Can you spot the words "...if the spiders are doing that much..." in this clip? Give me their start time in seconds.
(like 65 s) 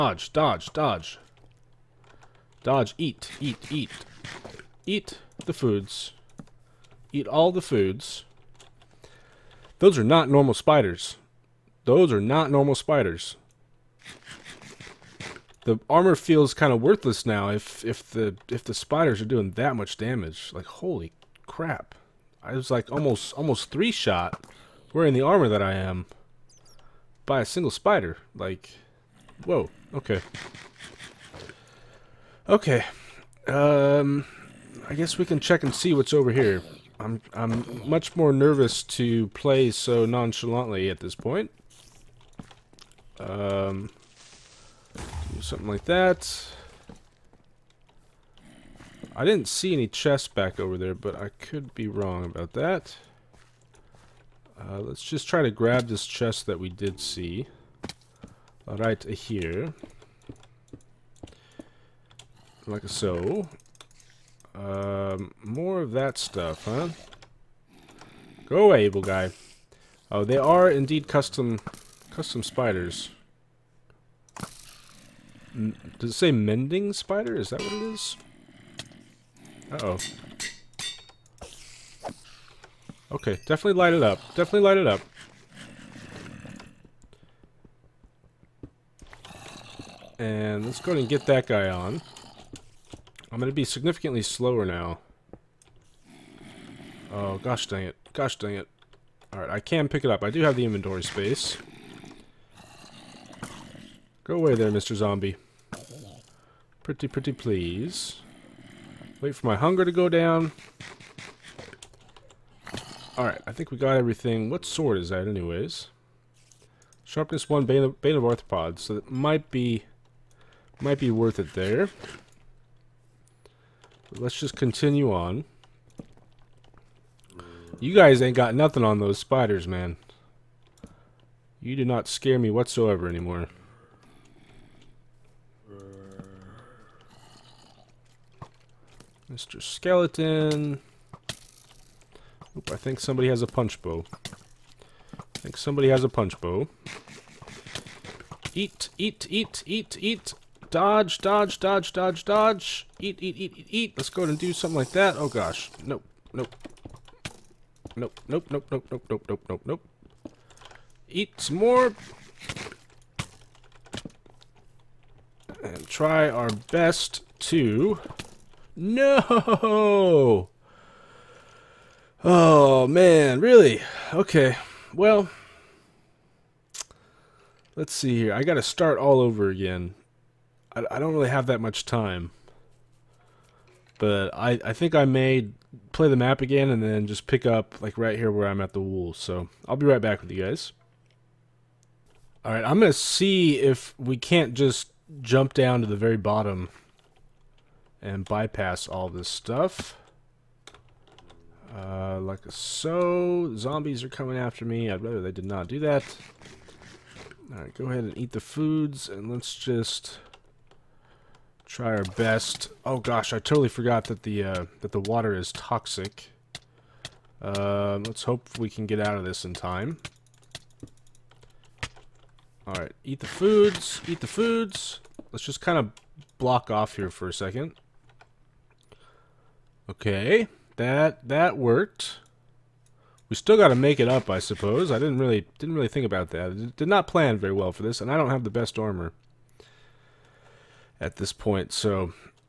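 18 s.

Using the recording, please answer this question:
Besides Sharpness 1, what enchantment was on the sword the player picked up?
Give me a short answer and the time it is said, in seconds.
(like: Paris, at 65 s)
Bane of Arthropods, at 117 s.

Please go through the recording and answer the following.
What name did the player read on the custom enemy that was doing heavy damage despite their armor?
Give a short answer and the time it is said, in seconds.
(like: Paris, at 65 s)
Mending spider, at 76 s.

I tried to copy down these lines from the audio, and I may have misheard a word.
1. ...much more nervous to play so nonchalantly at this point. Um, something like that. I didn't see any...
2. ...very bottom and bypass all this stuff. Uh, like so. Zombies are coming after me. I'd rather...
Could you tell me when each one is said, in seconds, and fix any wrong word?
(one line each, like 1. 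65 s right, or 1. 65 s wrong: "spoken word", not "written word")
1. 37 s right
2. 195 s right.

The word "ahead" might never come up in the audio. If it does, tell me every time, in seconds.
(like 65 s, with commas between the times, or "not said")
154 s, 207 s.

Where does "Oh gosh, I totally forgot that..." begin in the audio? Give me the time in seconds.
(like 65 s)
212 s.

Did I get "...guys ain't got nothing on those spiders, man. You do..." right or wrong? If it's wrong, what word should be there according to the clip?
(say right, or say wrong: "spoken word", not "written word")
right.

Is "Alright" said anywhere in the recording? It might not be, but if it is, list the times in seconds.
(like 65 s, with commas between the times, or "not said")
99 s, 113 s, 207 s, 222 s.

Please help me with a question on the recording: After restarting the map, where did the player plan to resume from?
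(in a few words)
The wool.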